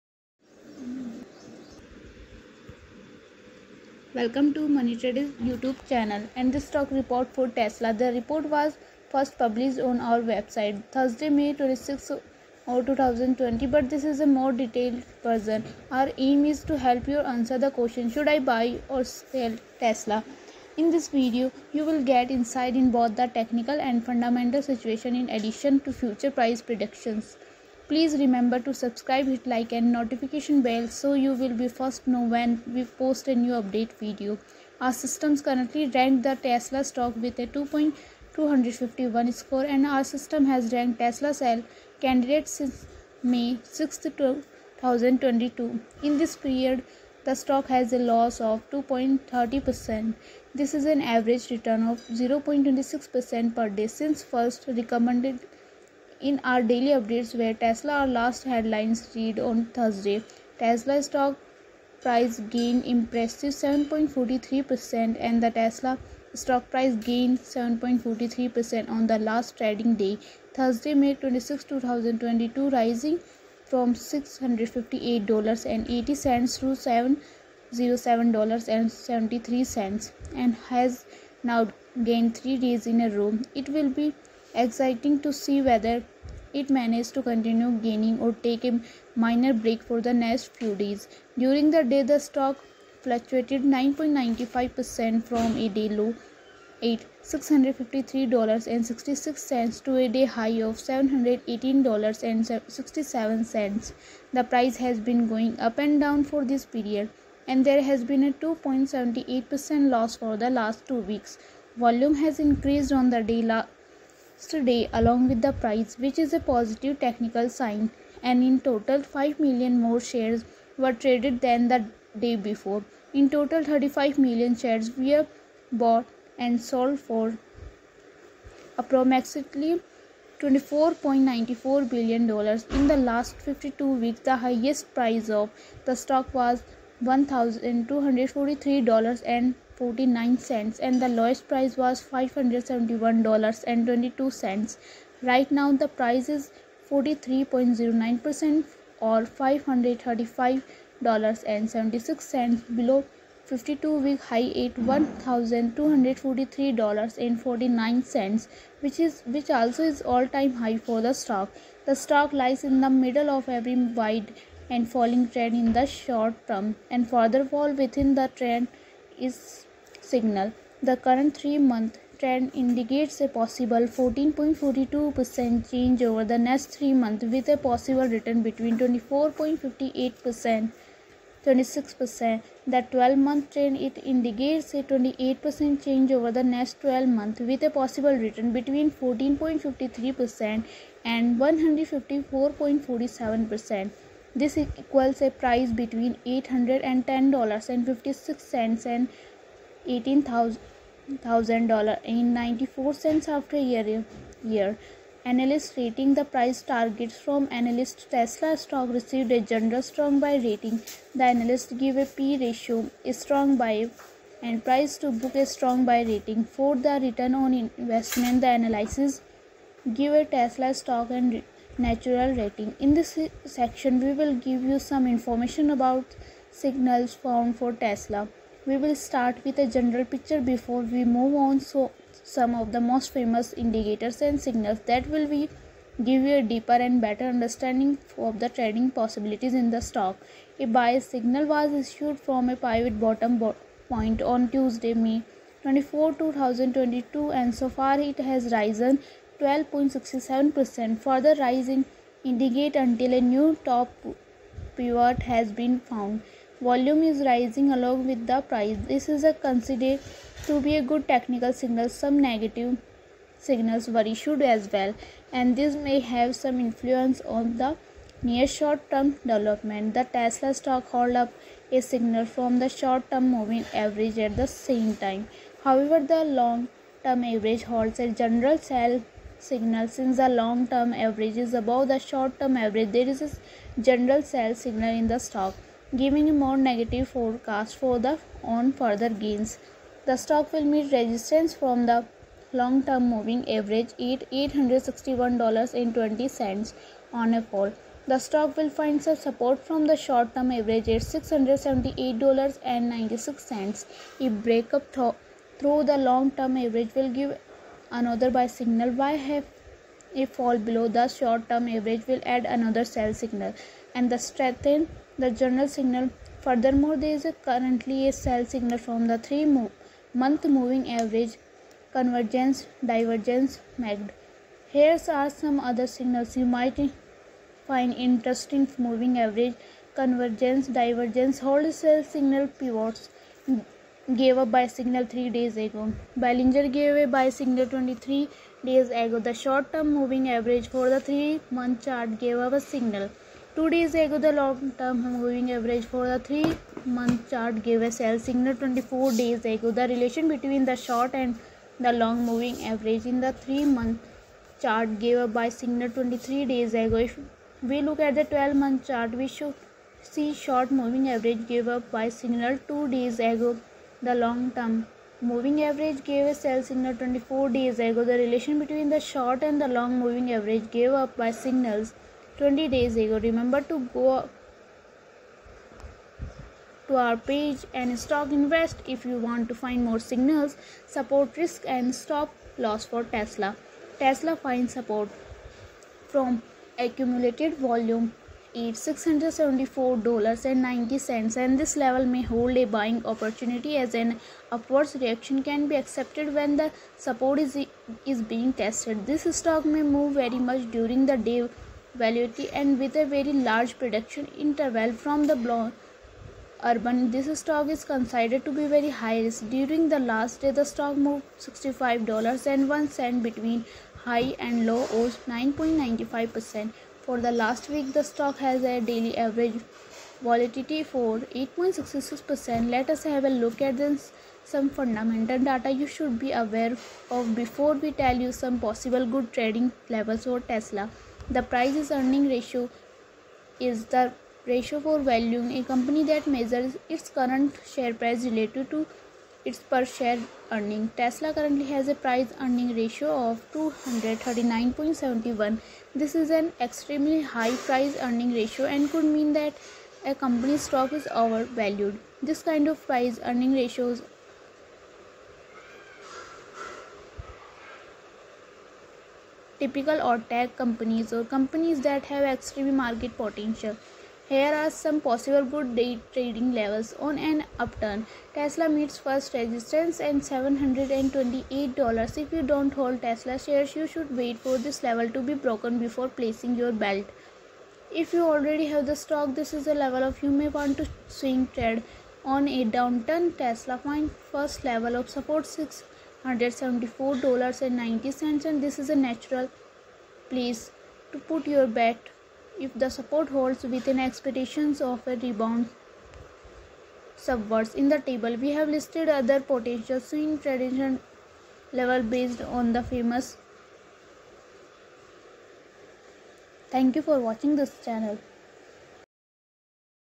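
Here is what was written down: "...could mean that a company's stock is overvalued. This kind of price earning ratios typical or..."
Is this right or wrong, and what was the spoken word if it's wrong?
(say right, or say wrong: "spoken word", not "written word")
right.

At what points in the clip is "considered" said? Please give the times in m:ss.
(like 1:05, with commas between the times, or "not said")
4:19, 6:47.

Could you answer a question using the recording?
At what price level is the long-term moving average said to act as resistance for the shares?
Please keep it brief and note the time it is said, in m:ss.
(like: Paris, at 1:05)
$861.20, at 4:54.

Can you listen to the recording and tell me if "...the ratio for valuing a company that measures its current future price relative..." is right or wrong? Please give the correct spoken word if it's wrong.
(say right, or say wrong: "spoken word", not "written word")
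wrong: "share", not "future".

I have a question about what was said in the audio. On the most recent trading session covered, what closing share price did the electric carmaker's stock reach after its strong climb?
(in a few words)
$707.73.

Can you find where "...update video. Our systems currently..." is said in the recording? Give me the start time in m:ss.
0:33.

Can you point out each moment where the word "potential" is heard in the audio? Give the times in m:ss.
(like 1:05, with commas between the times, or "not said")
7:43, 8:19.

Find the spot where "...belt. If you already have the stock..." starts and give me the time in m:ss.
7:56.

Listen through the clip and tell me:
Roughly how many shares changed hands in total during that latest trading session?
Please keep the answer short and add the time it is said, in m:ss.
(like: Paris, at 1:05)
35 million, at 2:03.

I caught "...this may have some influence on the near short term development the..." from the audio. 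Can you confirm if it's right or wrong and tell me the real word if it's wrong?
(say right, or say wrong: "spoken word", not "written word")
right.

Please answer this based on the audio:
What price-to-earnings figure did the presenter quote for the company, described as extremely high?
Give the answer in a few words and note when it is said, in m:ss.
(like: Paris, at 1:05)
239.71, at 7:23.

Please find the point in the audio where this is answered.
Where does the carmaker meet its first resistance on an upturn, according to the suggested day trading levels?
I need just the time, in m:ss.
7:50.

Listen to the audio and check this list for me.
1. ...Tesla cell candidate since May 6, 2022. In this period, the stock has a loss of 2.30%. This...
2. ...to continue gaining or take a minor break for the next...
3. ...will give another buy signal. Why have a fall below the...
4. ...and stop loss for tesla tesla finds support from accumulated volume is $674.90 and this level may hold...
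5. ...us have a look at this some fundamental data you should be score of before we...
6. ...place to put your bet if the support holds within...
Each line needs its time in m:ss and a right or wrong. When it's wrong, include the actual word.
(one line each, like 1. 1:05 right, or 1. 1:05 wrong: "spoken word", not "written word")
1. 0:40 right
2. 1:27 right
3. 5:06 right
4. 6:21 right
5. 7:02 wrong: "aware", not "score"
6. 8:10 right.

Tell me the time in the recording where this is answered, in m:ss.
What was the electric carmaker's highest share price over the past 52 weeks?
2:17.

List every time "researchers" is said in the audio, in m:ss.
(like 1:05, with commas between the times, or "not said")
not said.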